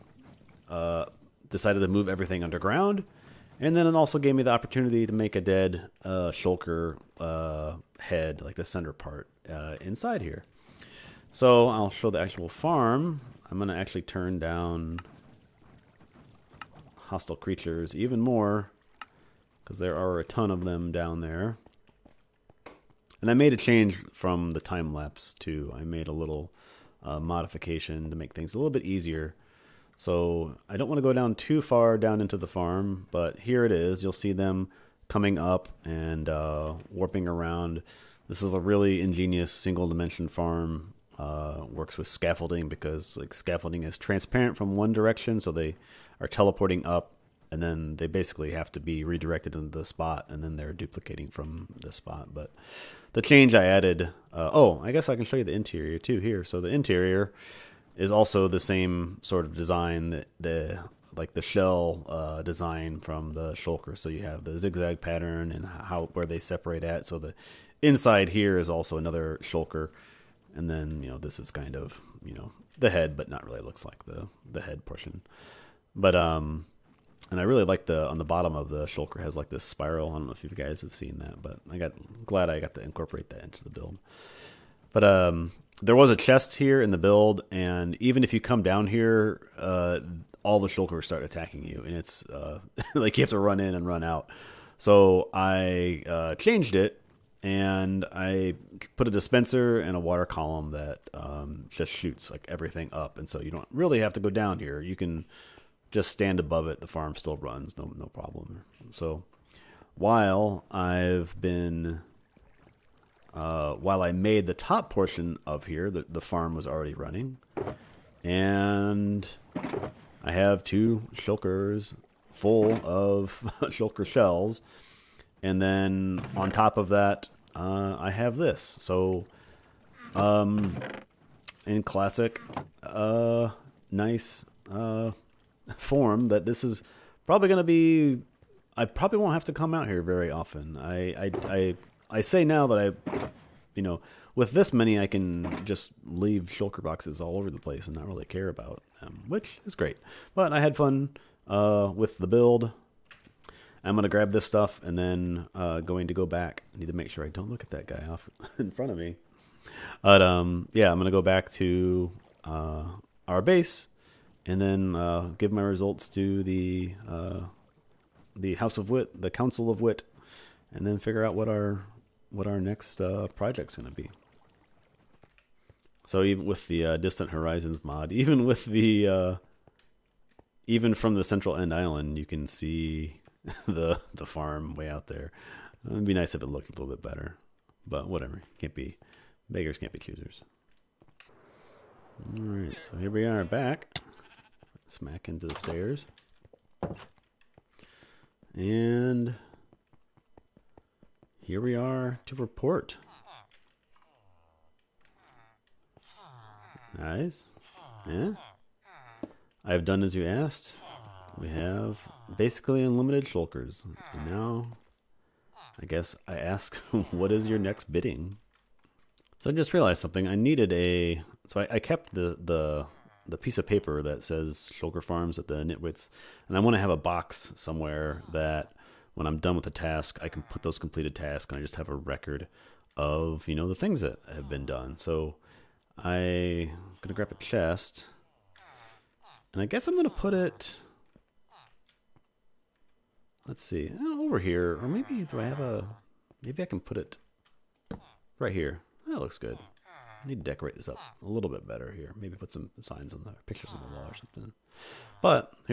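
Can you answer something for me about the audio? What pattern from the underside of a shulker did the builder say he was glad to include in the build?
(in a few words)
Spiral.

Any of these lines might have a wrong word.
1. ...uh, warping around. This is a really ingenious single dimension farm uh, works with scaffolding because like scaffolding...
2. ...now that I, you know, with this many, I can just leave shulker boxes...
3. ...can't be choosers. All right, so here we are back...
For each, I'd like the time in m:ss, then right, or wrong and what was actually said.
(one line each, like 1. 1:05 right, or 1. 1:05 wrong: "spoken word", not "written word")
1. 0:36 right
2. 2:22 right
3. 3:09 right.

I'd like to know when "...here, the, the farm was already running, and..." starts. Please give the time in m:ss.
1:55.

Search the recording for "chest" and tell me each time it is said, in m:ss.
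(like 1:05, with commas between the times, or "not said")
1:26, 3:57.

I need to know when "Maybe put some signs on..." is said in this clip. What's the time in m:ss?
4:12.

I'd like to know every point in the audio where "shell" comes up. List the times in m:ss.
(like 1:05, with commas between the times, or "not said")
1:01, 2:04.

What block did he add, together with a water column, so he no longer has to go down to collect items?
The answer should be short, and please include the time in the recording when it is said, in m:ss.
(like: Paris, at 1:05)
Dispenser, at 1:39.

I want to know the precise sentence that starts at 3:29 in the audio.
I have done as you asked we have basically unlimited shulkers.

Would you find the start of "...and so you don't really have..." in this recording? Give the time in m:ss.
1:43.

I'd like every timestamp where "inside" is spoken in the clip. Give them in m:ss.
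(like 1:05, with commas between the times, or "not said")
0:09, 1:07.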